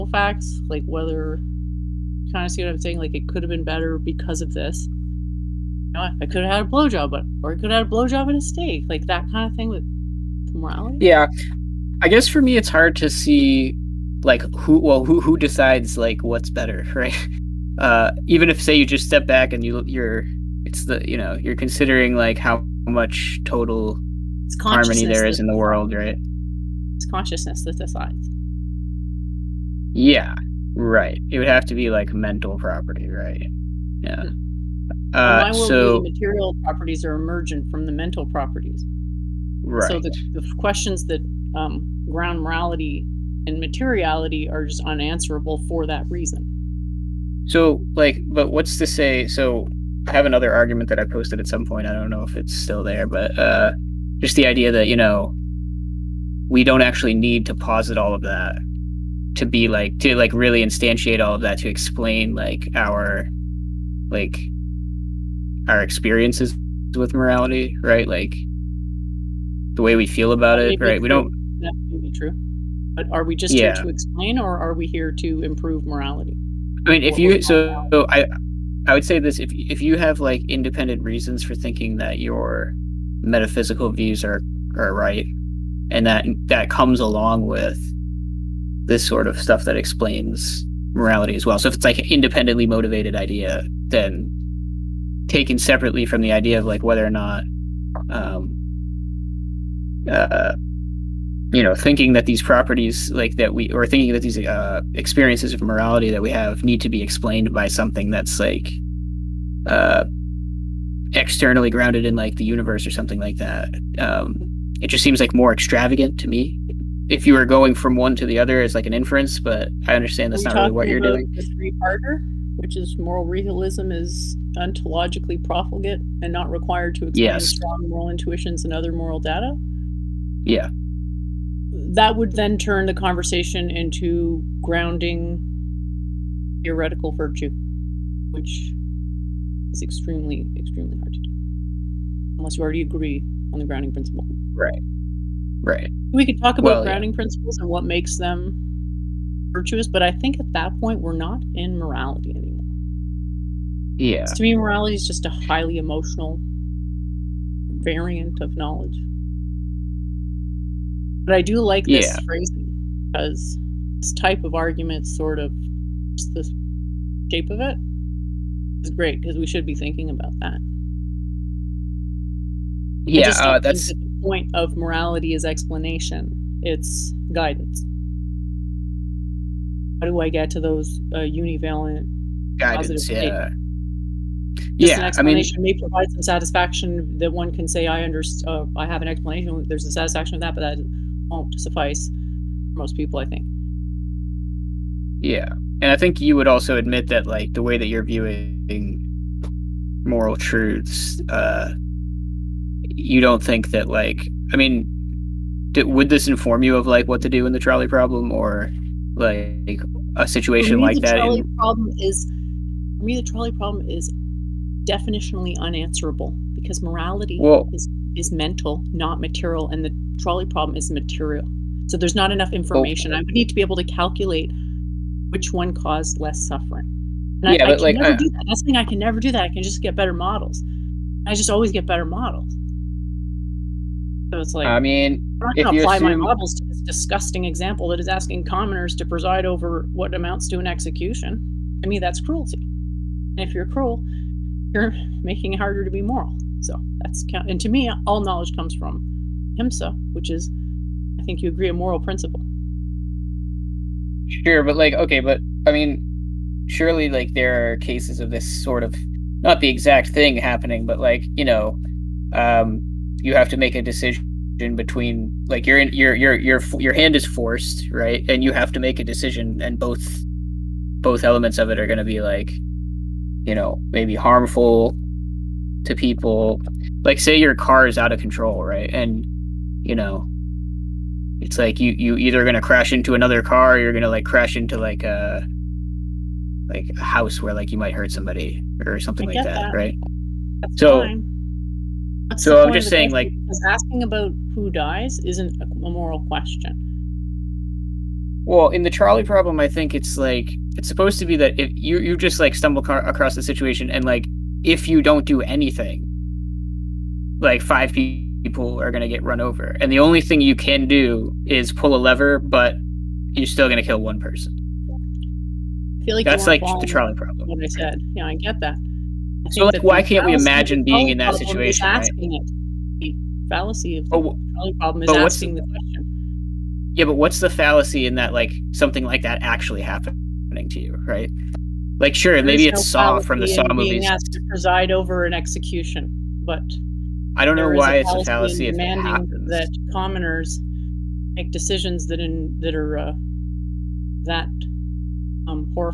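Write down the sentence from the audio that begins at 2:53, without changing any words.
Yeah, uh, that's that the point of morality is explanation.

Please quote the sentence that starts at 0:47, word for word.
So, like, but what's to say?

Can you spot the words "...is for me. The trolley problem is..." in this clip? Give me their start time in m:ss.
3:32.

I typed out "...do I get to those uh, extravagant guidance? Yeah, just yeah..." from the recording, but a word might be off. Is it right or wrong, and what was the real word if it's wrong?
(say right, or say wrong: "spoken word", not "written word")
wrong: "univalent", not "extravagant".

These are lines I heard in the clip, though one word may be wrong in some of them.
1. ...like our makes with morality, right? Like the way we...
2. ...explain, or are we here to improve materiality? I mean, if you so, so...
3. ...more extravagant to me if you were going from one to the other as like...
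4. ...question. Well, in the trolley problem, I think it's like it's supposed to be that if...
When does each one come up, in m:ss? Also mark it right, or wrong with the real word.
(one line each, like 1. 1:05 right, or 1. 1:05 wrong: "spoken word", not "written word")
1. 1:04 wrong: "experiences", not "makes"
2. 1:13 wrong: "morality", not "materiality"
3. 1:55 right
4. 4:56 right.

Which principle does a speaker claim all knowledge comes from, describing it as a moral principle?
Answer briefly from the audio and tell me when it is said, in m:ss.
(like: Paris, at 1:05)
Ahimsa, at 4:09.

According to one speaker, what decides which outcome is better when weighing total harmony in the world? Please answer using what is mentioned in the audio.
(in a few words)
Consciousness.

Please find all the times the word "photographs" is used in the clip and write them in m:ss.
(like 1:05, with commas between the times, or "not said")
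not said.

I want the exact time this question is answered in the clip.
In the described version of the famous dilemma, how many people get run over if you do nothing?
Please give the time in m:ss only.
5:07.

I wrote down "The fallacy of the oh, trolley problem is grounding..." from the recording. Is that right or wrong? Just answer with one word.
wrong.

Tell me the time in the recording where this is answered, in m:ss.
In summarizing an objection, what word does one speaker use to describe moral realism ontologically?
2:05.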